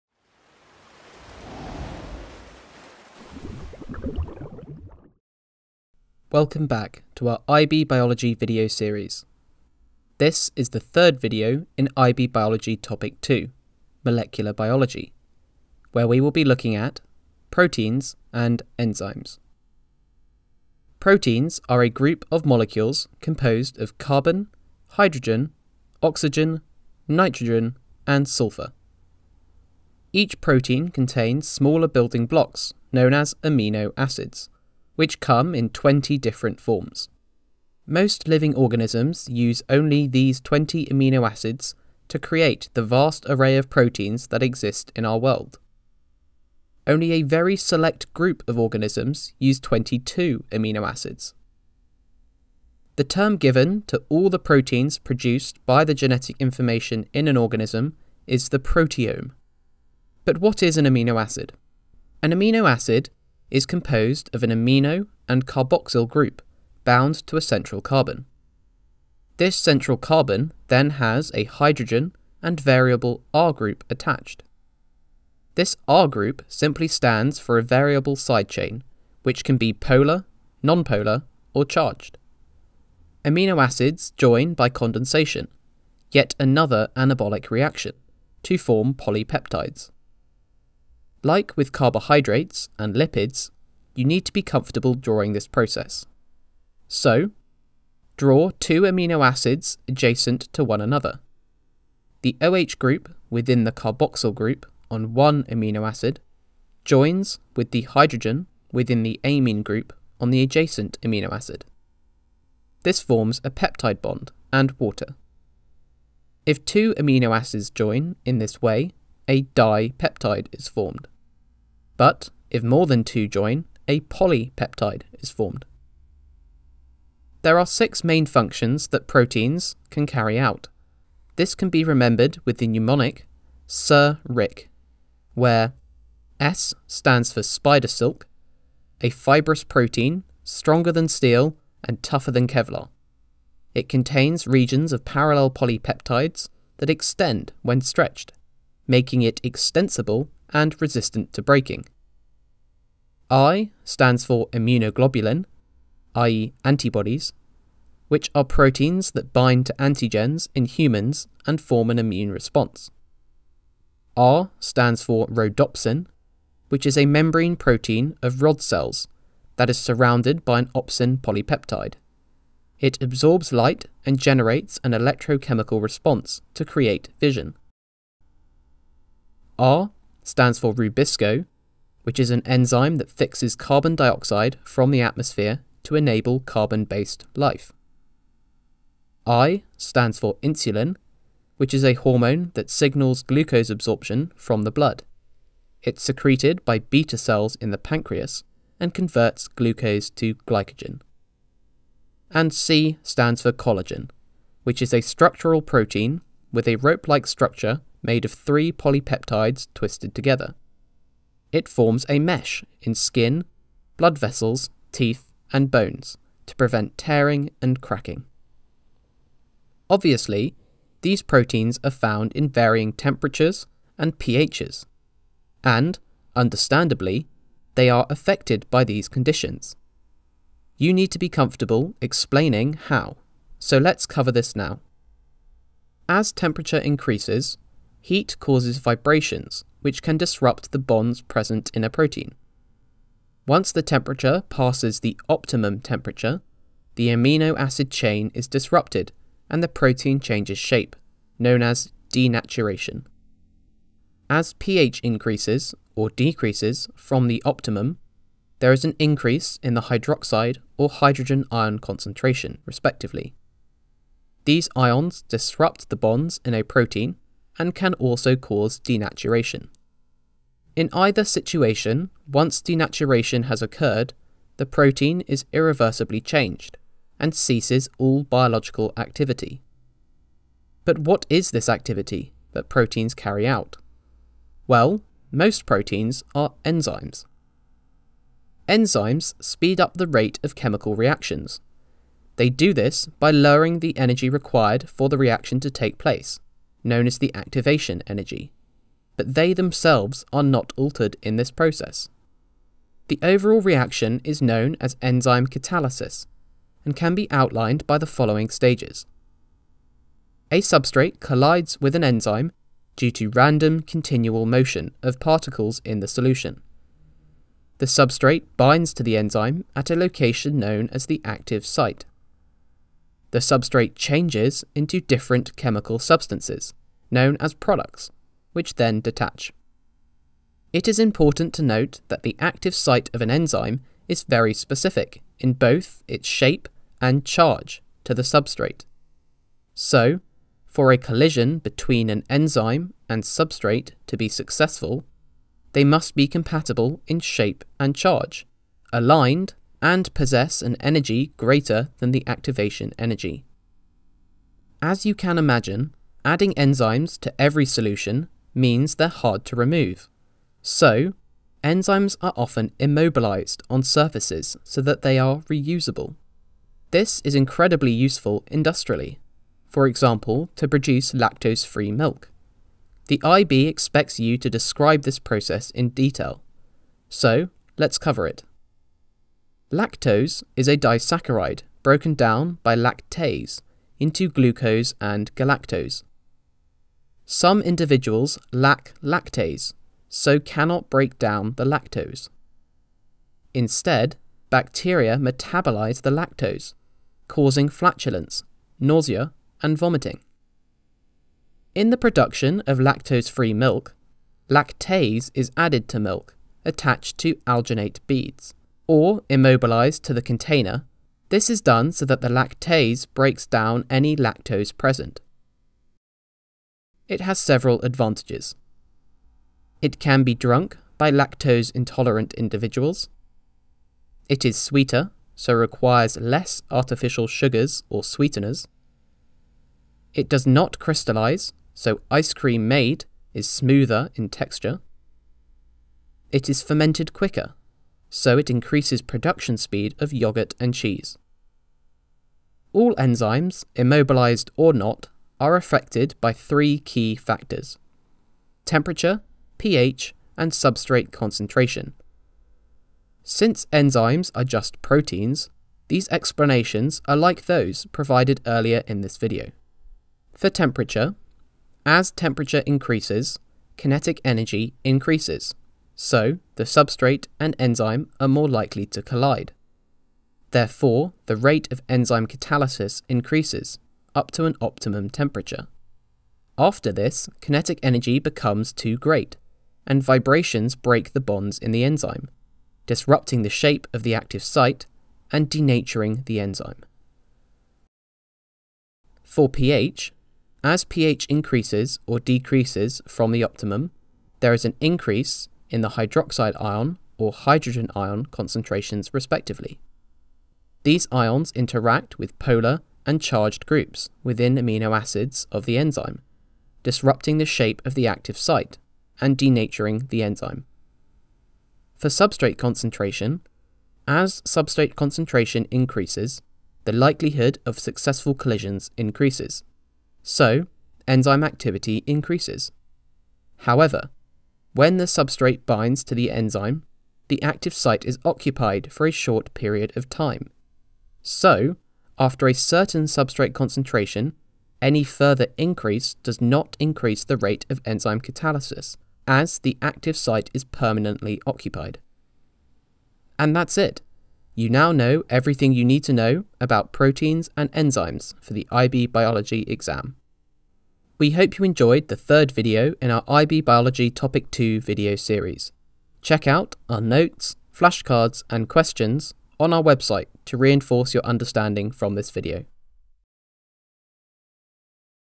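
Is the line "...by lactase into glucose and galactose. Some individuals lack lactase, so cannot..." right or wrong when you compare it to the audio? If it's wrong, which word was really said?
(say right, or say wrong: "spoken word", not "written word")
right.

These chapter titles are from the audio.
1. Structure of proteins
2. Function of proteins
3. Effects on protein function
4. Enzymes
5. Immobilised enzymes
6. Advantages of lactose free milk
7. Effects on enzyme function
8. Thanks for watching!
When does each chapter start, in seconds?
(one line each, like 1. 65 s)
1. 21 s
2. 127 s
3. 220 s
4. 288 s
5. 356 s
6. 420 s
7. 449 s
8. 551 s.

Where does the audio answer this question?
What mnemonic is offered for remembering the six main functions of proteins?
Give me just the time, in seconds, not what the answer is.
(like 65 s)
133 s.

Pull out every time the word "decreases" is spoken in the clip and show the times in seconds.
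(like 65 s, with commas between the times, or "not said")
256 s, 492 s.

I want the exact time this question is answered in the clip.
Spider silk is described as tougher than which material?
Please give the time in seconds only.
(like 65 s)
142 s.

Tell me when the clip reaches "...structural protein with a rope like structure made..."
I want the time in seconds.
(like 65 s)
205 s.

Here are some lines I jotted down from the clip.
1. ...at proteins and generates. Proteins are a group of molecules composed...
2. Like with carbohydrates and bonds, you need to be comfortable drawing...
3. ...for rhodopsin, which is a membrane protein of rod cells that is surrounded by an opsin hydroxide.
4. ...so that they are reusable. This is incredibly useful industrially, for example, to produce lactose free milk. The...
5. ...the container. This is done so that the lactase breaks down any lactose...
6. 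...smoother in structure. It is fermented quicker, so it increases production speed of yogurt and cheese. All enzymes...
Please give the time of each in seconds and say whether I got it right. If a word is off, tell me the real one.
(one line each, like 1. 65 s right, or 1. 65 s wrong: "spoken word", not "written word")
1. 16 s wrong: "enzymes", not "generates"
2. 91 s wrong: "lipids", not "bonds"
3. 165 s wrong: "polypeptide", not "hydroxide"
4. 364 s right
5. 410 s right
6. 433 s wrong: "texture", not "structure".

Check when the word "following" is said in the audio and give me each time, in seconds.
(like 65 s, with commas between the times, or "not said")
308 s.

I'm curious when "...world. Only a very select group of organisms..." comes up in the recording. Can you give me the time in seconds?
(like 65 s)
45 s.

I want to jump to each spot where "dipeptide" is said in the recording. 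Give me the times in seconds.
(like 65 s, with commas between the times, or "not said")
119 s.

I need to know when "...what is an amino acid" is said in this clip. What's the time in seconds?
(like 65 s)
60 s.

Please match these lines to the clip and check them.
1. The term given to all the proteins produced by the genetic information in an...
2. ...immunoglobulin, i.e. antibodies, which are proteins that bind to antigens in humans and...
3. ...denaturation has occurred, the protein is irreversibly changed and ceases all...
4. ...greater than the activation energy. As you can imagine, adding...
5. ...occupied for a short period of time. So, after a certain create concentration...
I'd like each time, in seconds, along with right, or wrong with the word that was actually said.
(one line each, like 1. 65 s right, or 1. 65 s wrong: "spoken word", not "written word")
1. 52 s right
2. 154 s right
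3. 272 s right
4. 351 s right
5. 528 s wrong: "substrate", not "create".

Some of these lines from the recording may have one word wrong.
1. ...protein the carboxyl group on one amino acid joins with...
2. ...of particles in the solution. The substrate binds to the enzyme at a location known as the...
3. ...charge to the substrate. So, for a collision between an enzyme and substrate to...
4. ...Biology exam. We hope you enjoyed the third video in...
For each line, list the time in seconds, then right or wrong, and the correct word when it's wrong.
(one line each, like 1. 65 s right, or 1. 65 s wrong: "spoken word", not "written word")
1. 103 s wrong: "within", not "protein"
2. 315 s right
3. 337 s right
4. 549 s right.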